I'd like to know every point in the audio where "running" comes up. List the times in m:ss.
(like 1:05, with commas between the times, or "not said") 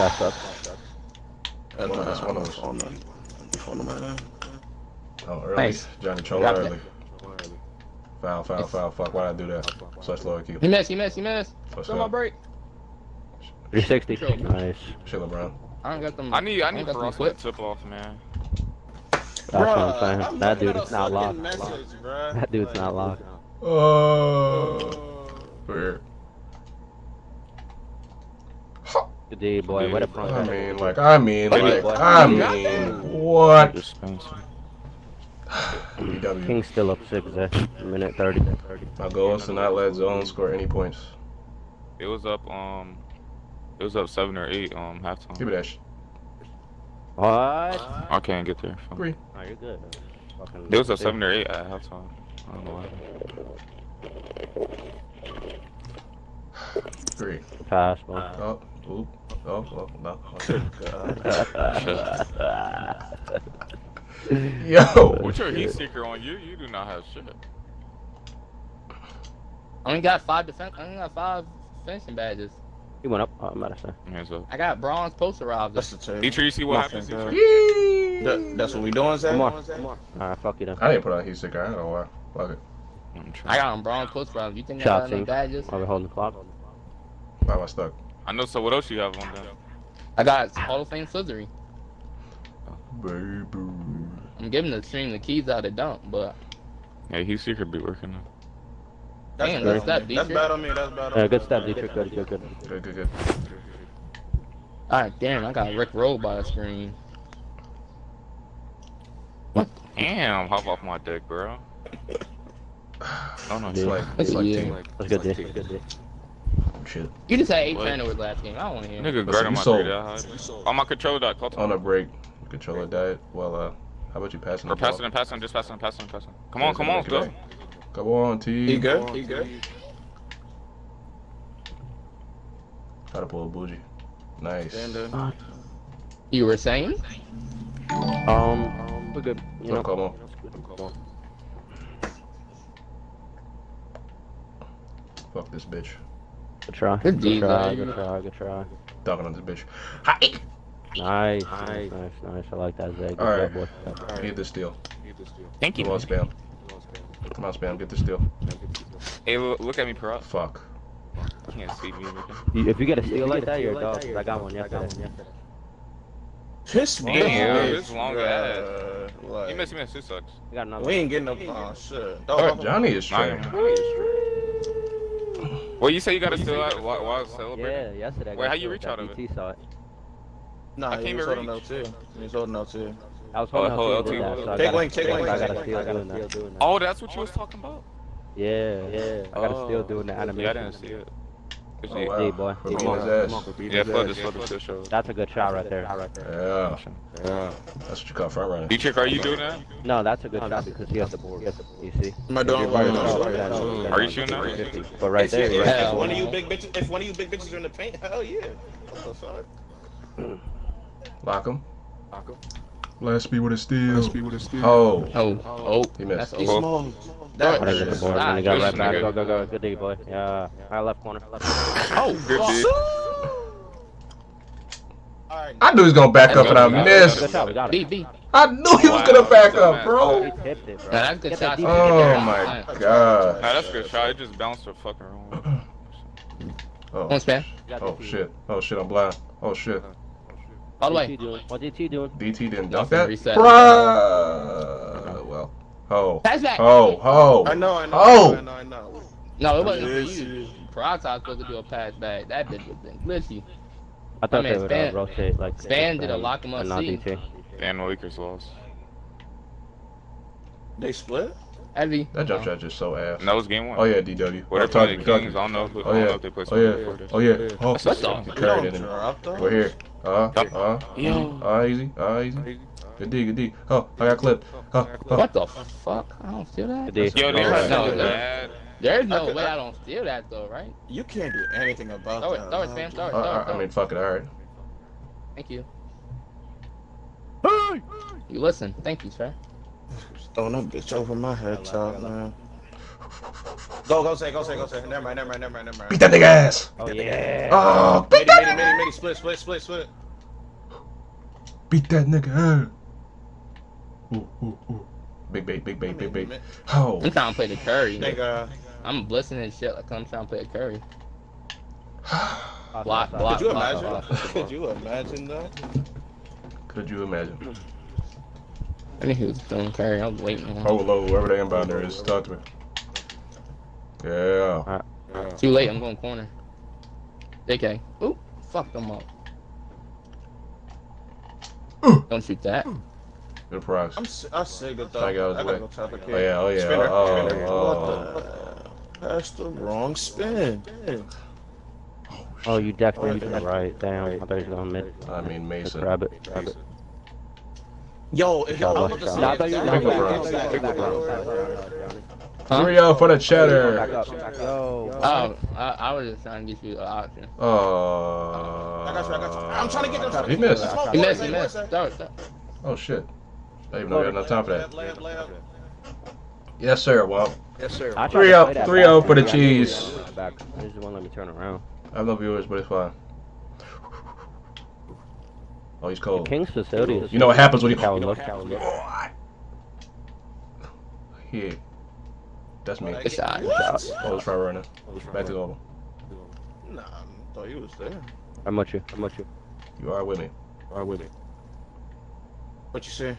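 3:18, 6:24.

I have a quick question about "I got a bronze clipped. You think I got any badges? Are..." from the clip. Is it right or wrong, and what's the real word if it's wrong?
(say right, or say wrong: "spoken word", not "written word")
wrong: "robbed", not "clipped".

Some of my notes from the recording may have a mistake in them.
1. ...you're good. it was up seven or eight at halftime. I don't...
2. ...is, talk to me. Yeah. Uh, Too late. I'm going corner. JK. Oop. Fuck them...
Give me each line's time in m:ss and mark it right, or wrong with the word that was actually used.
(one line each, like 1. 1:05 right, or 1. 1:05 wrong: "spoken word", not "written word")
1. 0:49 right
2. 5:21 right.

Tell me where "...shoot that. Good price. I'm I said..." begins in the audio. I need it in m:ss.
5:32.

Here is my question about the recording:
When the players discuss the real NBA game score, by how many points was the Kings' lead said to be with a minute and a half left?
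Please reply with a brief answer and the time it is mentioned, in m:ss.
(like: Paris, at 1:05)
6, at 0:36.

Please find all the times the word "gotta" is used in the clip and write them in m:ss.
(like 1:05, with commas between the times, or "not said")
3:05, 3:09, 5:35.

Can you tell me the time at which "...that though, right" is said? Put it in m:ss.
4:40.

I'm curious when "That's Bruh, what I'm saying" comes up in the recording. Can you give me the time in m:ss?
0:19.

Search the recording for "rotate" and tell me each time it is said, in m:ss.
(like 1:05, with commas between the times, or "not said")
4:14.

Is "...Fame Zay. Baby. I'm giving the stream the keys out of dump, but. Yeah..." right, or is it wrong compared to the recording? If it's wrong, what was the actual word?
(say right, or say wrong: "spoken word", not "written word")
wrong: "Slithery", not "Zay".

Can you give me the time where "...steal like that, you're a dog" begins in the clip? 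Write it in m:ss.
2:43.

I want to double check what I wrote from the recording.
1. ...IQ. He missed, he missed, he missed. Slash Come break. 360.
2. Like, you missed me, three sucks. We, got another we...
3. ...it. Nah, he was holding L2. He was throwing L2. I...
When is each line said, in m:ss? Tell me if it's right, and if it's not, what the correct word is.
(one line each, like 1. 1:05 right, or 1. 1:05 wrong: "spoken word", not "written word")
1. 0:10 right
2. 2:49 wrong: "two", not "three"
3. 2:59 wrong: "holding", not "throwing".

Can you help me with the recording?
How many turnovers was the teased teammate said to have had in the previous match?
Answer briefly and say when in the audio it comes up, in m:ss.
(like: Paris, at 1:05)
8, at 1:57.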